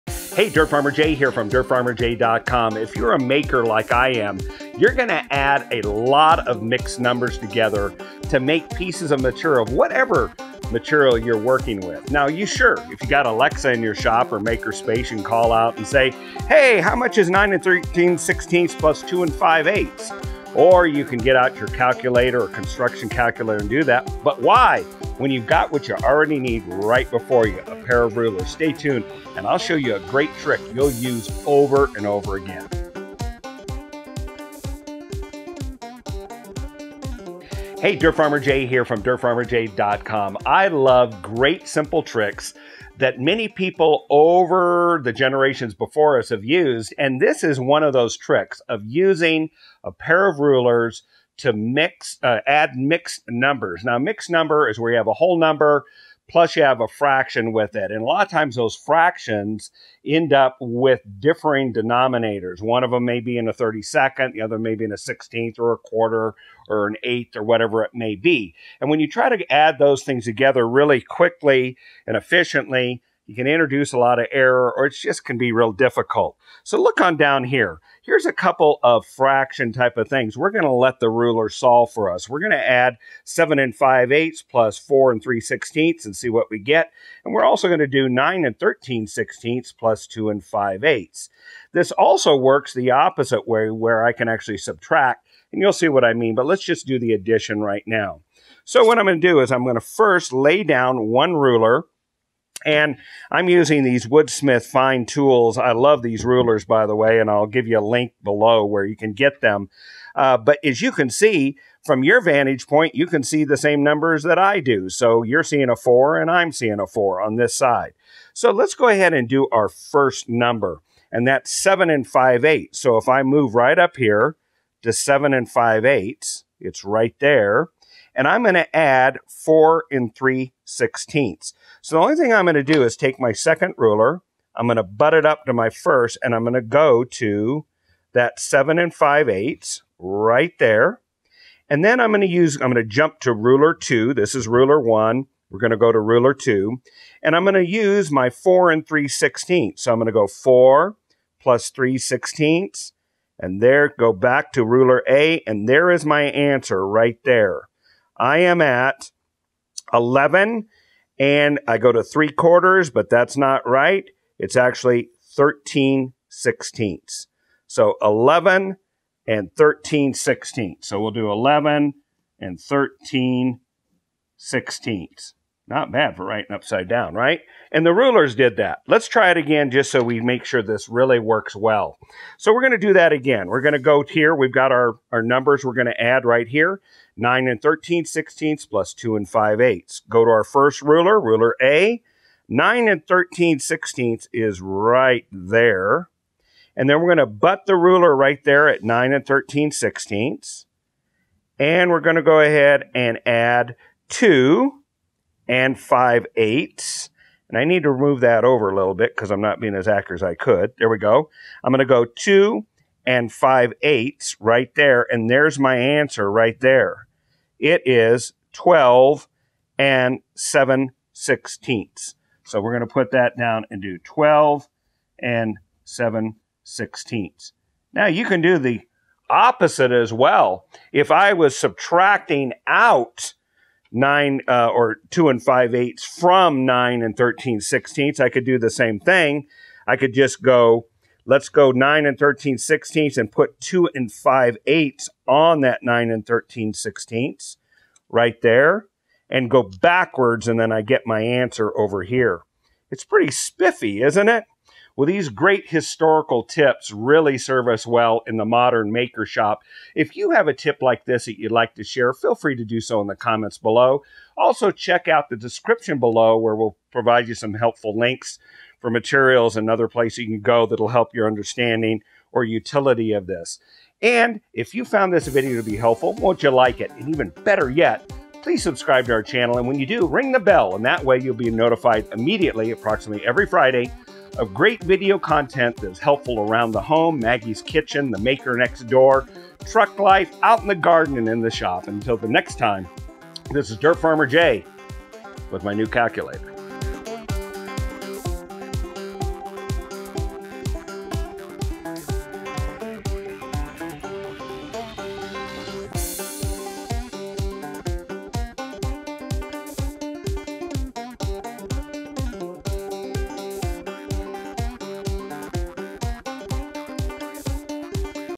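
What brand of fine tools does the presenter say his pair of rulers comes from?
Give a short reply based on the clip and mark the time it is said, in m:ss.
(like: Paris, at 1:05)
Woodsmith, at 1:44.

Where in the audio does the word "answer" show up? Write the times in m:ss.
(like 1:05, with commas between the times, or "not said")
2:36, 3:35, 4:11.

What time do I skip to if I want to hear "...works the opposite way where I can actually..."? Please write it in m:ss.
1:32.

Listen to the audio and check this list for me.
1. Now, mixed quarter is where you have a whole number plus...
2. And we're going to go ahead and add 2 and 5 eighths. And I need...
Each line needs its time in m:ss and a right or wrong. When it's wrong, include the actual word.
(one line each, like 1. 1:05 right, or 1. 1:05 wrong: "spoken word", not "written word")
1. 0:53 wrong: "number", not "quarter"
2. 3:21 right.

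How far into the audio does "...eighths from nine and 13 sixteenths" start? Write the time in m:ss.
3:55.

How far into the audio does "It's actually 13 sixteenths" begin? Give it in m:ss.
2:44.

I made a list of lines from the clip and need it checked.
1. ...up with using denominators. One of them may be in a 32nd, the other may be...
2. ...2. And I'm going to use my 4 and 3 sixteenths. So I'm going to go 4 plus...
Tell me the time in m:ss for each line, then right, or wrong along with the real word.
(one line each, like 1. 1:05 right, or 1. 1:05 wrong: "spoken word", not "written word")
1. 1:00 wrong: "differing", not "using"
2. 2:26 right.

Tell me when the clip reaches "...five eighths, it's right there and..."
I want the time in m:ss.
2:05.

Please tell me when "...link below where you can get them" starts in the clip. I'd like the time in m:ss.
1:47.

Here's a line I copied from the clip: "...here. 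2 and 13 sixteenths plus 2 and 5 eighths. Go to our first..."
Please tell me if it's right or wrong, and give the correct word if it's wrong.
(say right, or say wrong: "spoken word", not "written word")
wrong: "9", not "2".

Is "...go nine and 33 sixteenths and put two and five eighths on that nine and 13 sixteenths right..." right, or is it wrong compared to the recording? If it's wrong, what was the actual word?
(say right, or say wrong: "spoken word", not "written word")
wrong: "13", not "33".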